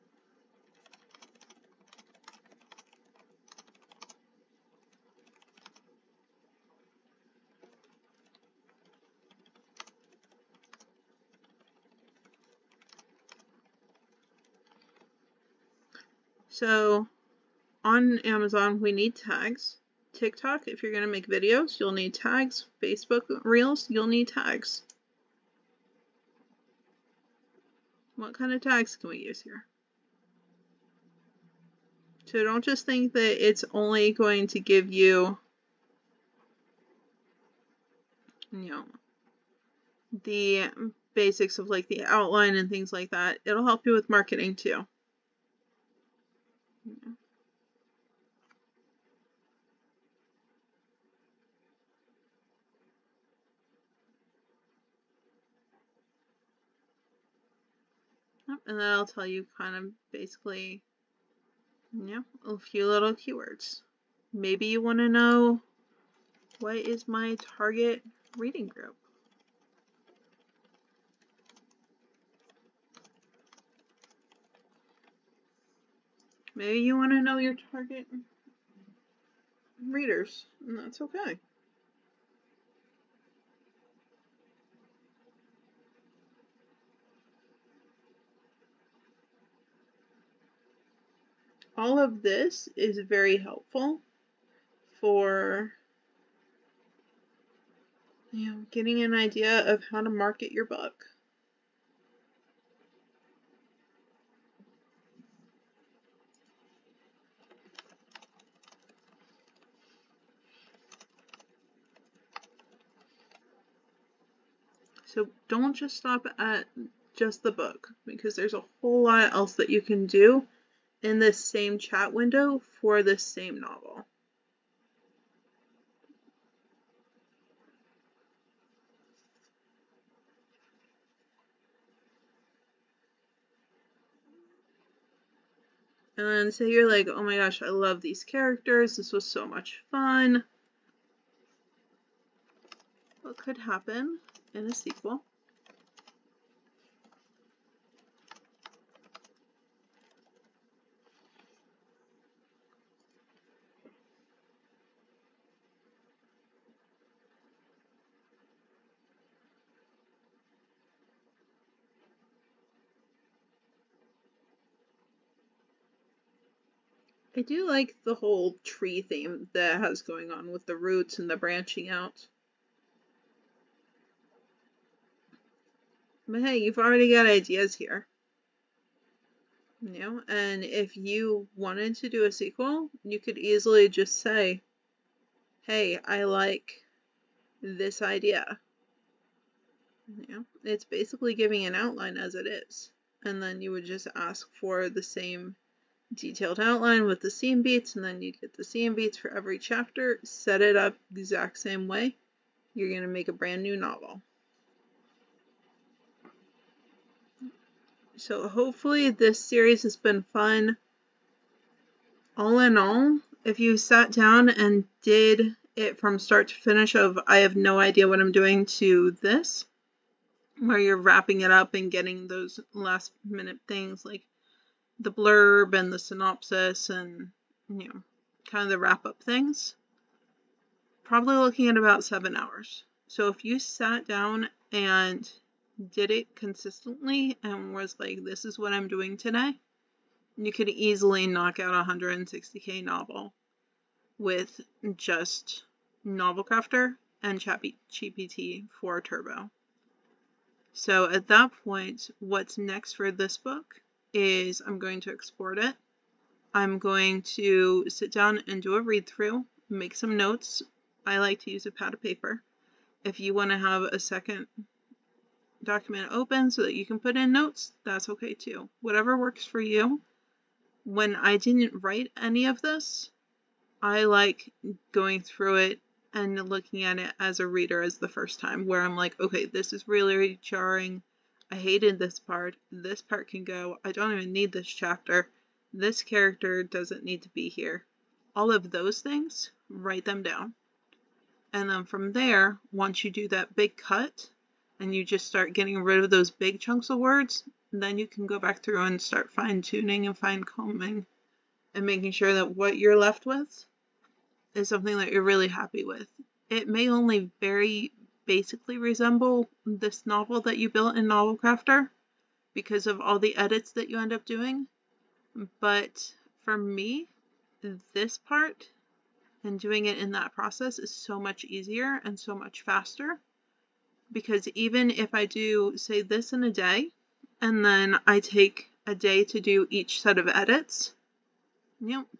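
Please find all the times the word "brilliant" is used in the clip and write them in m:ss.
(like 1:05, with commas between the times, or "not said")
not said.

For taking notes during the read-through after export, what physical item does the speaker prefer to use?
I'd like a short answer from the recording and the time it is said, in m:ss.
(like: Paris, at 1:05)
A pad of paper, at 4:21.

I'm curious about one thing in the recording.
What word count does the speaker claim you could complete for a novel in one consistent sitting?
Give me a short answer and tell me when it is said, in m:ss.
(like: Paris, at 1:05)
160k, at 4:01.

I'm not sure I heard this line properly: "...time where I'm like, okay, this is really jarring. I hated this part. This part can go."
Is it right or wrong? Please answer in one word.
right.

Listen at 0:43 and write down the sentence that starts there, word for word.
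It'll help you with marketing too.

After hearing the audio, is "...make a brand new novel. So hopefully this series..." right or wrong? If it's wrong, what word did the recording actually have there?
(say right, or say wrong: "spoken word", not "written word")
right.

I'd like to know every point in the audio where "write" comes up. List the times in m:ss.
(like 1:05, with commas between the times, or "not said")
4:31, 4:49.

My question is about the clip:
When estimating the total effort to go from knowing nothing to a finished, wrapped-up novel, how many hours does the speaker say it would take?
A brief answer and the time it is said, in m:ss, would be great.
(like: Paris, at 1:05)
7 hours, at 3:52.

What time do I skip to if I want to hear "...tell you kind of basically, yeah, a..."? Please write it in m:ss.
0:59.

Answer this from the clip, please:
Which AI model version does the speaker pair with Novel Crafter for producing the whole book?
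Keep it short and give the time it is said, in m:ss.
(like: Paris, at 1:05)
ChatGPT 4 Turbo, at 4:07.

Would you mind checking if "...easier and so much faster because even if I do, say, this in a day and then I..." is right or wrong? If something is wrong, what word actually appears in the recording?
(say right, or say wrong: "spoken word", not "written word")
right.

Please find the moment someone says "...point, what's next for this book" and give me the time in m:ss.
4:11.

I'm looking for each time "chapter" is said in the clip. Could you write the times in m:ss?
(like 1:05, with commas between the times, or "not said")
3:19, 4:44.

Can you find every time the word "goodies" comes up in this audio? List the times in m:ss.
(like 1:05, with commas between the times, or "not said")
not said.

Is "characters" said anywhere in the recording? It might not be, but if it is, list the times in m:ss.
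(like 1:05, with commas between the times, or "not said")
2:18, 4:46.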